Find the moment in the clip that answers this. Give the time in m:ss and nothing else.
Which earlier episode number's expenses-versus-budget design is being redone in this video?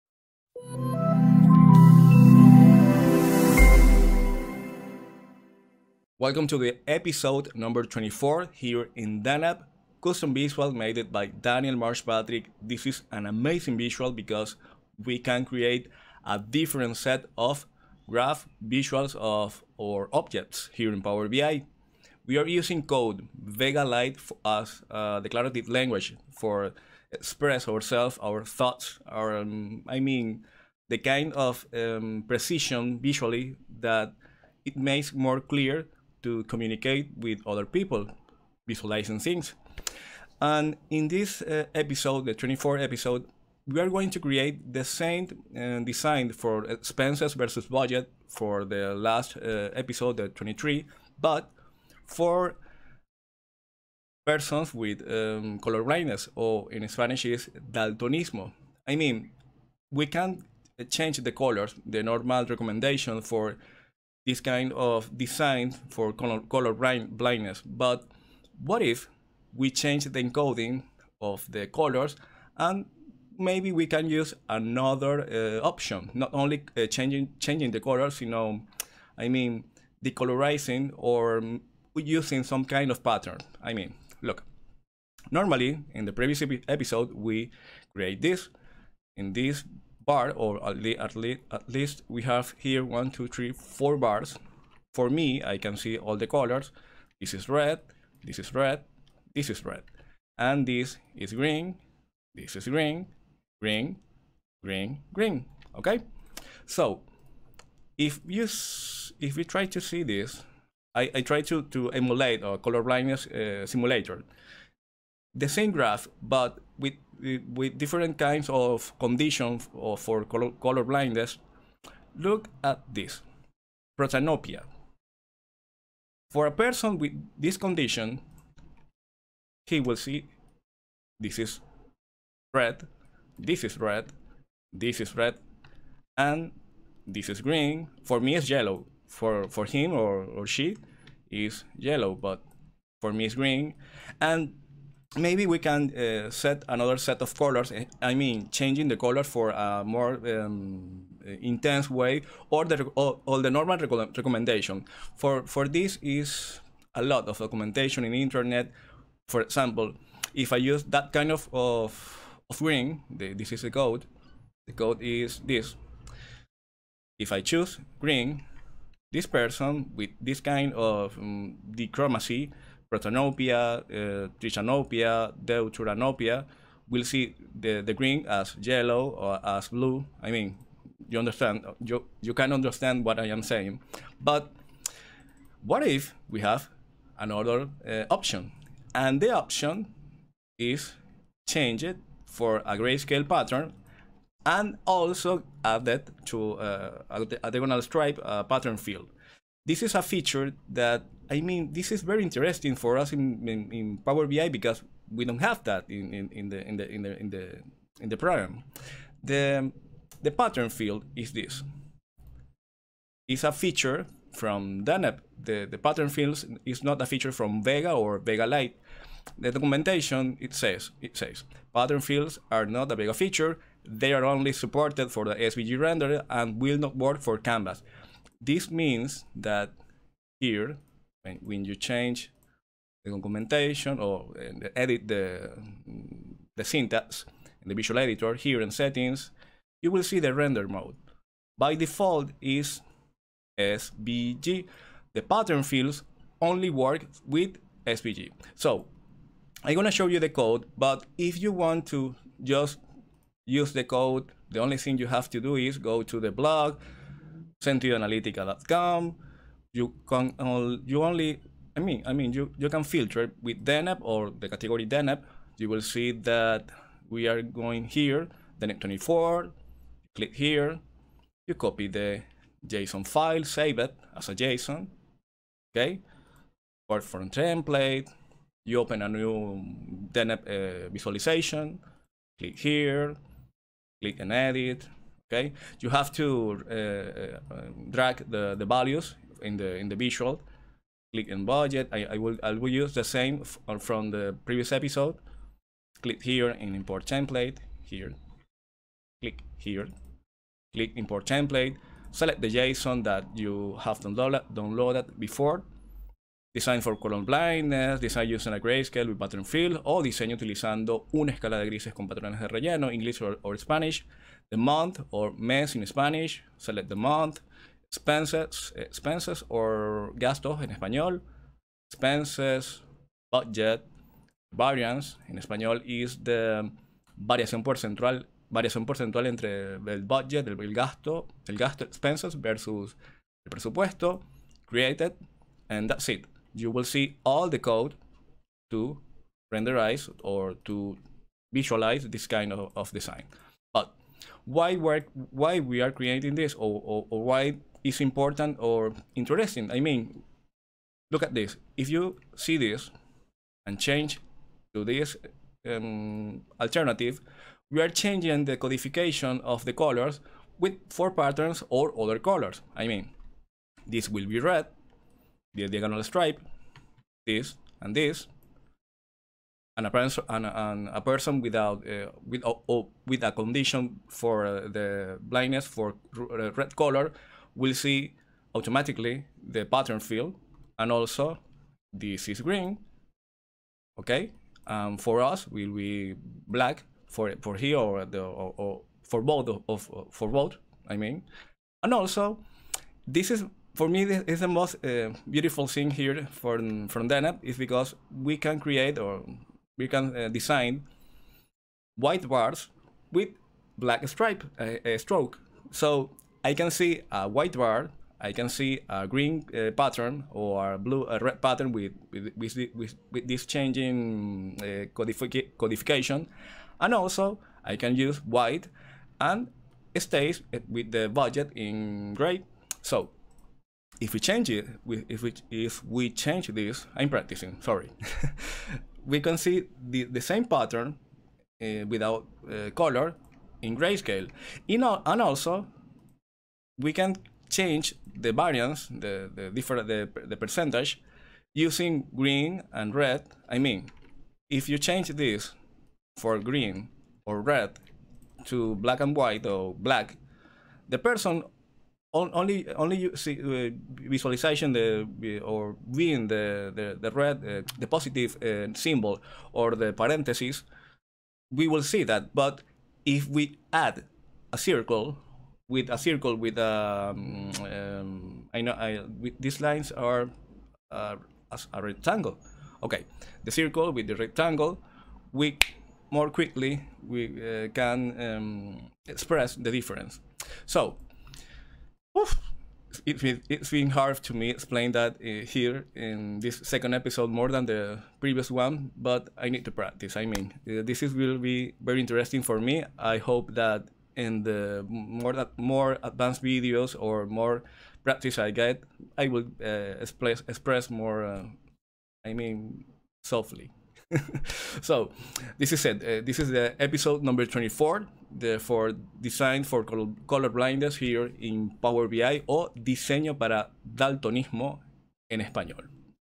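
0:50.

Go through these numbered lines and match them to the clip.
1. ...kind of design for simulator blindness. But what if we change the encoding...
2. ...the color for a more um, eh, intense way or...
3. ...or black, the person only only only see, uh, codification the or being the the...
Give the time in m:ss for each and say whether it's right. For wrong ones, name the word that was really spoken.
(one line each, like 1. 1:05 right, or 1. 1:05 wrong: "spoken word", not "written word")
1. 1:04 wrong: "color", not "simulator"
2. 2:28 right
3. 7:29 wrong: "visualization", not "codification".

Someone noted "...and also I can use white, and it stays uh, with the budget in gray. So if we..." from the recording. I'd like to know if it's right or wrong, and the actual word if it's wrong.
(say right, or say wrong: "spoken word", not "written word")
right.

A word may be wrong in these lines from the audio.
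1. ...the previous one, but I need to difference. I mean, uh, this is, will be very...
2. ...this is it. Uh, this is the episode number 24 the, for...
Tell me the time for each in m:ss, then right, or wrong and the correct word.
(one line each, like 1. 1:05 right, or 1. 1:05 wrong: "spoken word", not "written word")
1. 8:07 wrong: "practice", not "difference"
2. 8:25 right.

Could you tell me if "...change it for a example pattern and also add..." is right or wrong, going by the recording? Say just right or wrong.
wrong.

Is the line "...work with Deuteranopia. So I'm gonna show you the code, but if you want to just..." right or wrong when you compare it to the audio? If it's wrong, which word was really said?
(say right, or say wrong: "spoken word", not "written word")
wrong: "SVG", not "Deuteranopia".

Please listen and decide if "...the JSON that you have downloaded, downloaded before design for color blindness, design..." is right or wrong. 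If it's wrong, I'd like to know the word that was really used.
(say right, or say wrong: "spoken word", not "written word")
right.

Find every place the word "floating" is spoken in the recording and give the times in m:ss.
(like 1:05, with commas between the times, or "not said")
not said.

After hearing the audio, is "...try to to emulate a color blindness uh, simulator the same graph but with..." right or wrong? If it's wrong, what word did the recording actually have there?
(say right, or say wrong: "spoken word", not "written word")
right.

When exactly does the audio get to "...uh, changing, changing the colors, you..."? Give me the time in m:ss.
1:16.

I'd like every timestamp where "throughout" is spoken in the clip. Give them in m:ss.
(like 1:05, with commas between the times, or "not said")
not said.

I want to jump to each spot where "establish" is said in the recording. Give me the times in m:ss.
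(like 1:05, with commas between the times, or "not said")
not said.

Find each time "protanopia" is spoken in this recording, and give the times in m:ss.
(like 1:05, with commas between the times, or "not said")
2:03, 2:52.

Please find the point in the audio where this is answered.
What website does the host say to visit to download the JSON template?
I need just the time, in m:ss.
4:17.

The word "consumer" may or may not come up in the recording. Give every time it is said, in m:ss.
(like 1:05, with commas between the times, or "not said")
not said.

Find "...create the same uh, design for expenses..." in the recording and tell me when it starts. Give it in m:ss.
0:44.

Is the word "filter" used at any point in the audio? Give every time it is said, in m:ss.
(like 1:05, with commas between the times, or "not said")
4:22.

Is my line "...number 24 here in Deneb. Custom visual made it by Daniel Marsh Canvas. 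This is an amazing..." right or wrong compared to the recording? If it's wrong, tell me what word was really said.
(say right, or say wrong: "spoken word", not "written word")
wrong: "Patrick", not "Canvas".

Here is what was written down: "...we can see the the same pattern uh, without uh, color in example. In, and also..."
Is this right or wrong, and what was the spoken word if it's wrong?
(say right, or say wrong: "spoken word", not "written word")
wrong: "grayscale", not "example".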